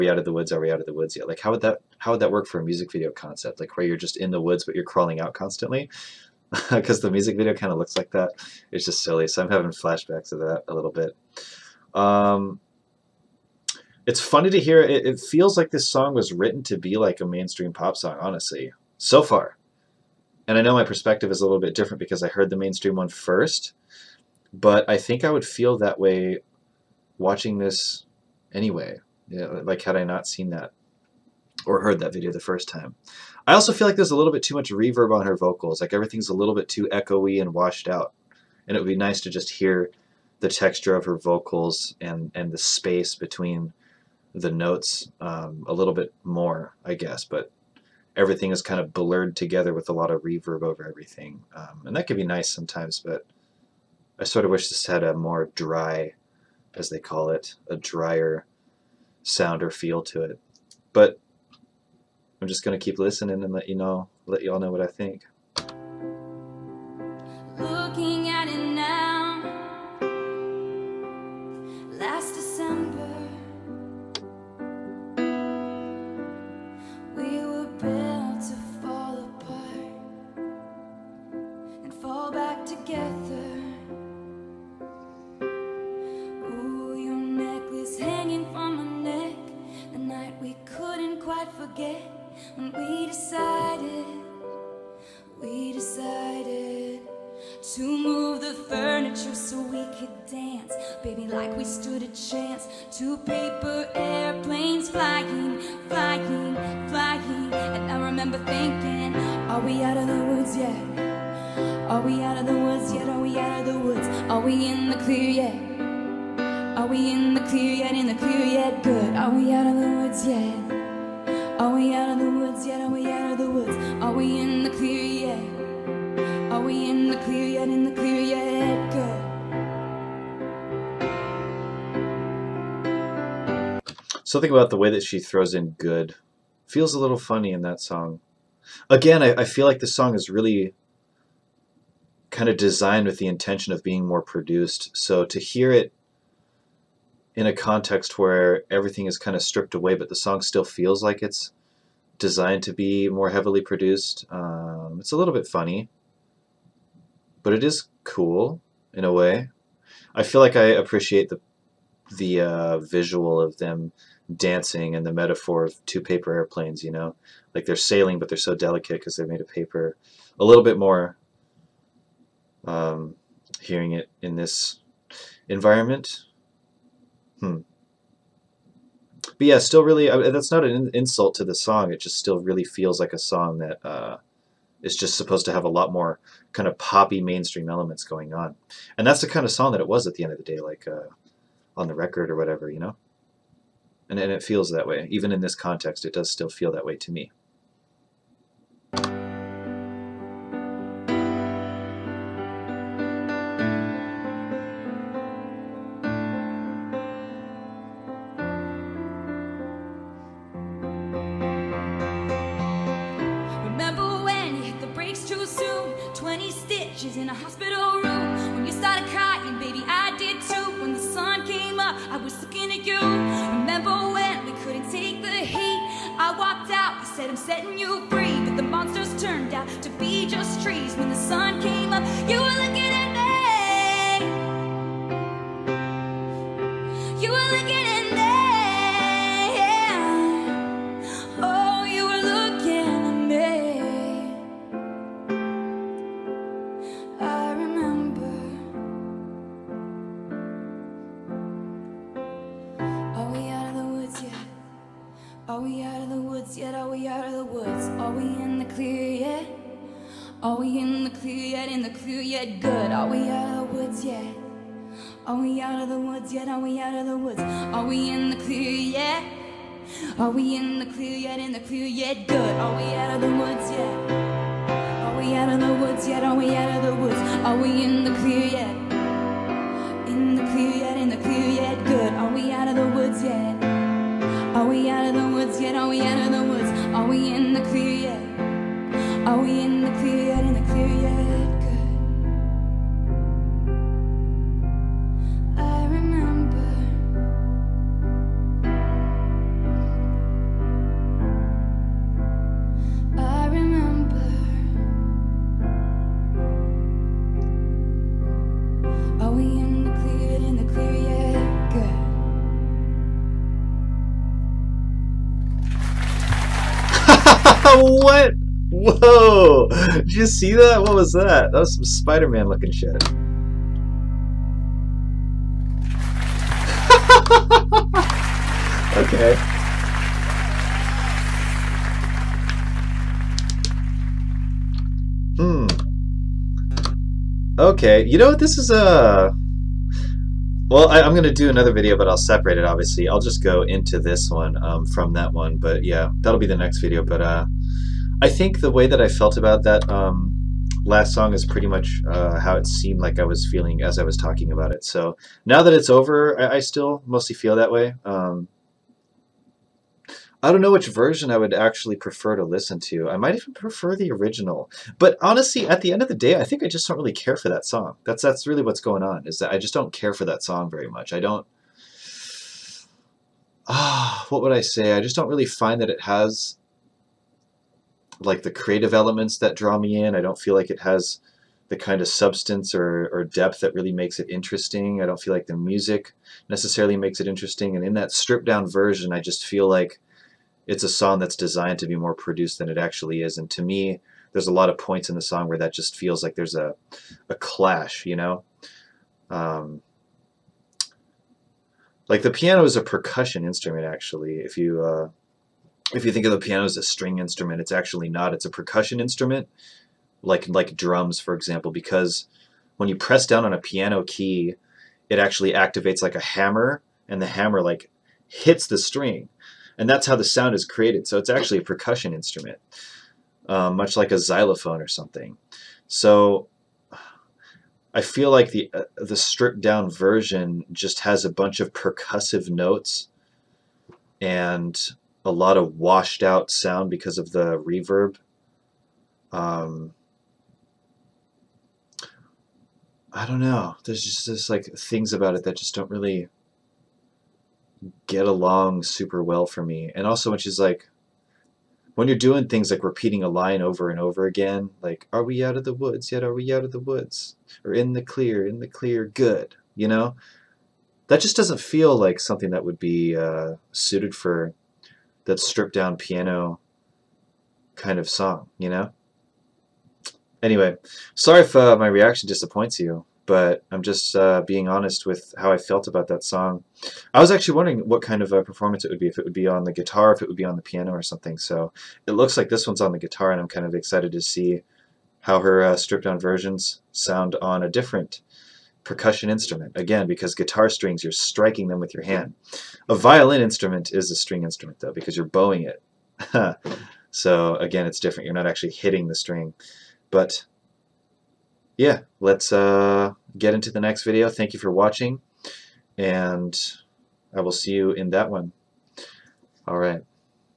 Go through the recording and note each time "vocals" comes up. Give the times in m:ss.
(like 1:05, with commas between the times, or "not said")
0:35, 0:41.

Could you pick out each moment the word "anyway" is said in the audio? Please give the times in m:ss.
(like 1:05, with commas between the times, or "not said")
0:28, 7:50.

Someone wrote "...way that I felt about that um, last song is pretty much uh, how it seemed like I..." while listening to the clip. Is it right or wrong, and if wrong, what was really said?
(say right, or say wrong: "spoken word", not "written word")
right.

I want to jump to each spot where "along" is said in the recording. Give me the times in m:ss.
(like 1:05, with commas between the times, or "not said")
7:28.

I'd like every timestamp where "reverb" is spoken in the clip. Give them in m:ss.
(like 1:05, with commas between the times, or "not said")
0:34, 0:50, 7:17.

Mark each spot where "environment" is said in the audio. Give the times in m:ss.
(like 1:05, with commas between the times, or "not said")
2:55.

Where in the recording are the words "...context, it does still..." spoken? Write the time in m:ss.
3:15.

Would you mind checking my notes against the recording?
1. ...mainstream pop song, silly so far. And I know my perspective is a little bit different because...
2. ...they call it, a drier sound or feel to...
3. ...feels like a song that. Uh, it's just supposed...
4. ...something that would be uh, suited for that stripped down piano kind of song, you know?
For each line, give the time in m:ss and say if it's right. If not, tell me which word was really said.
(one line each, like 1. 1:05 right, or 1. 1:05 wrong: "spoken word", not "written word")
1. 0:17 wrong: "honestly", not "silly"
2. 0:56 right
3. 3:02 right
4. 7:42 right.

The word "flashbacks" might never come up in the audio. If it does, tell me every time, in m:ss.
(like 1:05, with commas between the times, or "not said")
0:09.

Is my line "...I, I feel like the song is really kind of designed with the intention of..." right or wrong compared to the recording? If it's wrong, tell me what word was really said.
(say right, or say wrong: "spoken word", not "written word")
right.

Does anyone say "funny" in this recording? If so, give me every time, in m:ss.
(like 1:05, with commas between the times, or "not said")
0:14, 2:17, 2:35.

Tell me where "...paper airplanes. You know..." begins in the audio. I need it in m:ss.
2:46.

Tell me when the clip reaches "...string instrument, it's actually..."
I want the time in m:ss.
6:46.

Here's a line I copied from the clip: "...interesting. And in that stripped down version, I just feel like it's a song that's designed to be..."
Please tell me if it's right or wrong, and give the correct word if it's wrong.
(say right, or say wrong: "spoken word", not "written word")
right.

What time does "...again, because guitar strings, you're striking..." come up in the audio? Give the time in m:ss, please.
8:09.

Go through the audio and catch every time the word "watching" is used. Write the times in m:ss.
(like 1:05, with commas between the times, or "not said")
0:27, 8:24.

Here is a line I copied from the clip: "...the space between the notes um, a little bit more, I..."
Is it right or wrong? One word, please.
right.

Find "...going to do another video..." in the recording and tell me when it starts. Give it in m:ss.
5:41.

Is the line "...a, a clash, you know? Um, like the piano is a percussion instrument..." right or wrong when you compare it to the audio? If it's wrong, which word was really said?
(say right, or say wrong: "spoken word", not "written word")
right.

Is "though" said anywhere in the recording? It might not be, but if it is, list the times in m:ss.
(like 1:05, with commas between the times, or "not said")
8:14.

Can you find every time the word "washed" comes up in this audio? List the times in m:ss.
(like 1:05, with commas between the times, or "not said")
0:37, 7:15.